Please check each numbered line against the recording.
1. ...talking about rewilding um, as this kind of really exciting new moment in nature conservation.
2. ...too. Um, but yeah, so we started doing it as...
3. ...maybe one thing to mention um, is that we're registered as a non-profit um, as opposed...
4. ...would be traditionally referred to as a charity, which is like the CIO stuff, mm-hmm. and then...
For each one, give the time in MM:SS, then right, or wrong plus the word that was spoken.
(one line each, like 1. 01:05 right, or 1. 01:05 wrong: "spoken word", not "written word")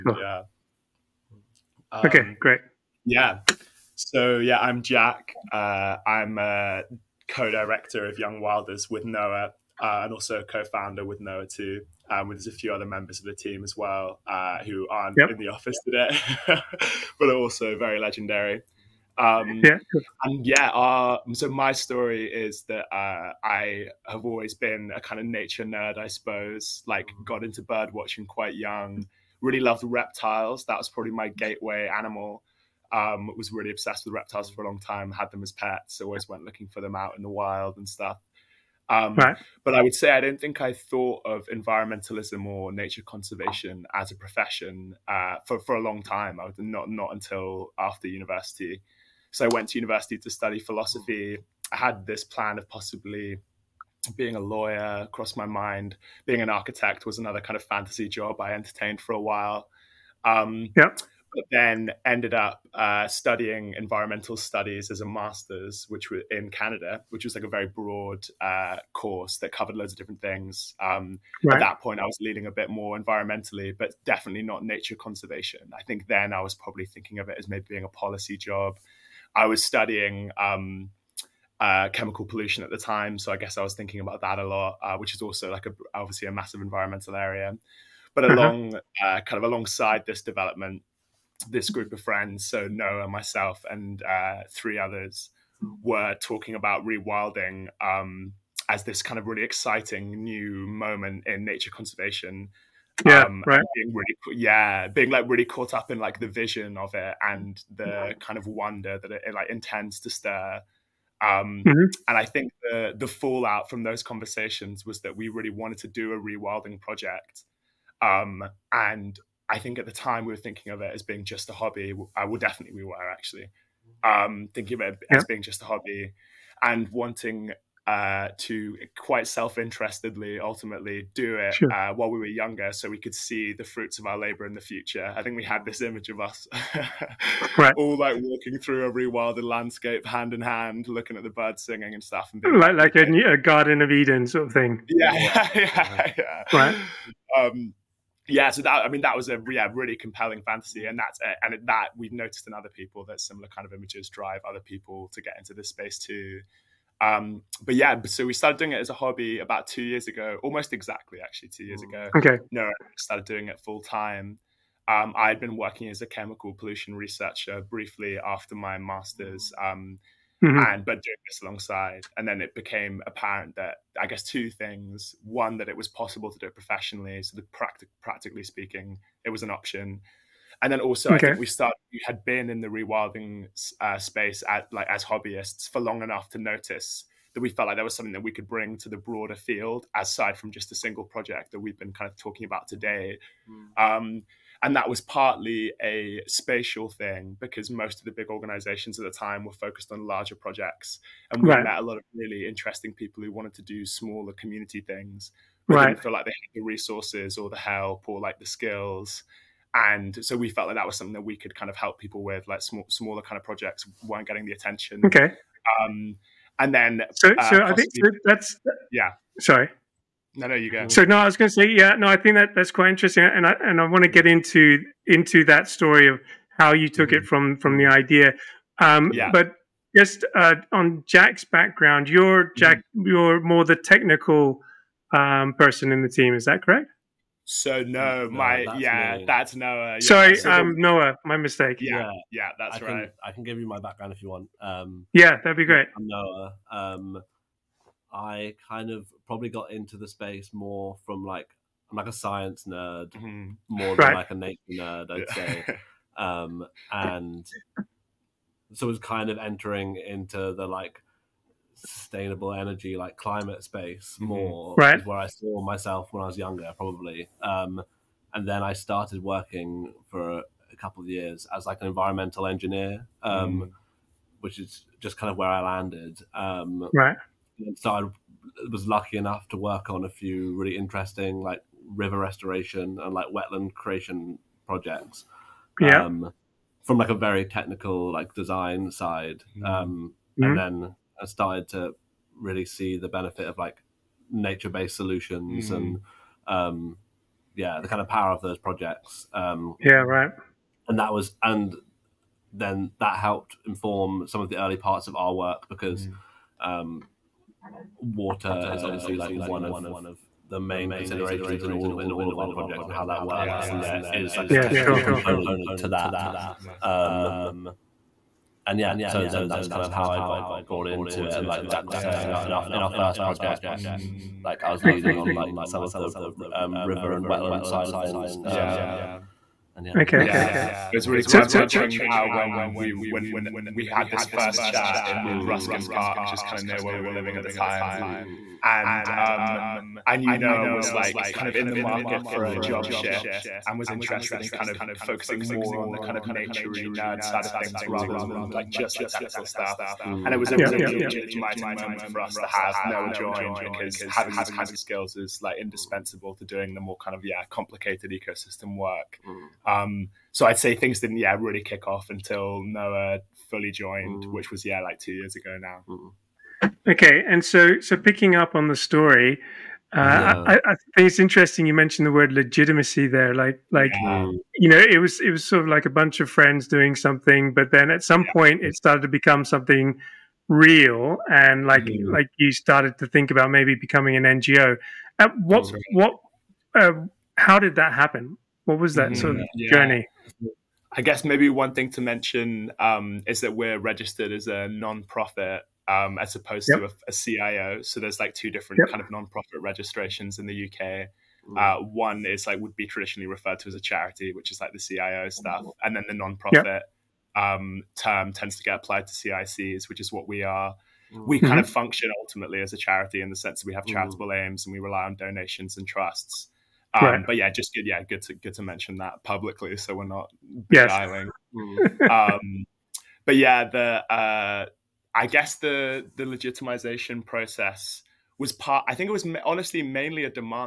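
1. 01:36 right
2. 02:35 right
3. 06:31 right
4. 06:42 right.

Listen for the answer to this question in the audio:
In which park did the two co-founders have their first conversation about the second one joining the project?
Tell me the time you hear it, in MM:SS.
05:35.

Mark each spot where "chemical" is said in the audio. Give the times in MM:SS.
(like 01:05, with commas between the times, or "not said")
01:21, 02:46.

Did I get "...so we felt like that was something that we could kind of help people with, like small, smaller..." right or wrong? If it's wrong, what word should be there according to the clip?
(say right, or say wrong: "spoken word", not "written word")
right.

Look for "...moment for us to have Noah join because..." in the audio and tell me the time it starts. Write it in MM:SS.
05:51.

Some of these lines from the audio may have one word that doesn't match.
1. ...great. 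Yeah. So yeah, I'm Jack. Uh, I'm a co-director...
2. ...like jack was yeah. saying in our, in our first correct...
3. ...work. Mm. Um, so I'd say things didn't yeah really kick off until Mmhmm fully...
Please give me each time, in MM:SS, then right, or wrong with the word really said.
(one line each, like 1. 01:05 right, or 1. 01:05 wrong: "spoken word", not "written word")
1. 00:02 right
2. 05:21 wrong: "project", not "correct"
3. 05:58 wrong: "Noah", not "Mmhmm".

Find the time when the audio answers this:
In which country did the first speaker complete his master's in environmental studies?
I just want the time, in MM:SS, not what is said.
01:06.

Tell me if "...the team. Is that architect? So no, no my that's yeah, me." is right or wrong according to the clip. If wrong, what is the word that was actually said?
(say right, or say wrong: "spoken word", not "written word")
wrong: "correct", not "architect".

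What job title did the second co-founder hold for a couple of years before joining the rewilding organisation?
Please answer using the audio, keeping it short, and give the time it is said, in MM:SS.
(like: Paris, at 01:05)
Environmental engineer, at 04:31.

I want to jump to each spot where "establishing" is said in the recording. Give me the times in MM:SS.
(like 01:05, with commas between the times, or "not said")
not said.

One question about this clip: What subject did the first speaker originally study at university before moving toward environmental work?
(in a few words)
Philosophy.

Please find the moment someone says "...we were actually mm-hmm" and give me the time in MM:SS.
02:02.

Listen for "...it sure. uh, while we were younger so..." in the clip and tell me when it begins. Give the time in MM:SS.
02:11.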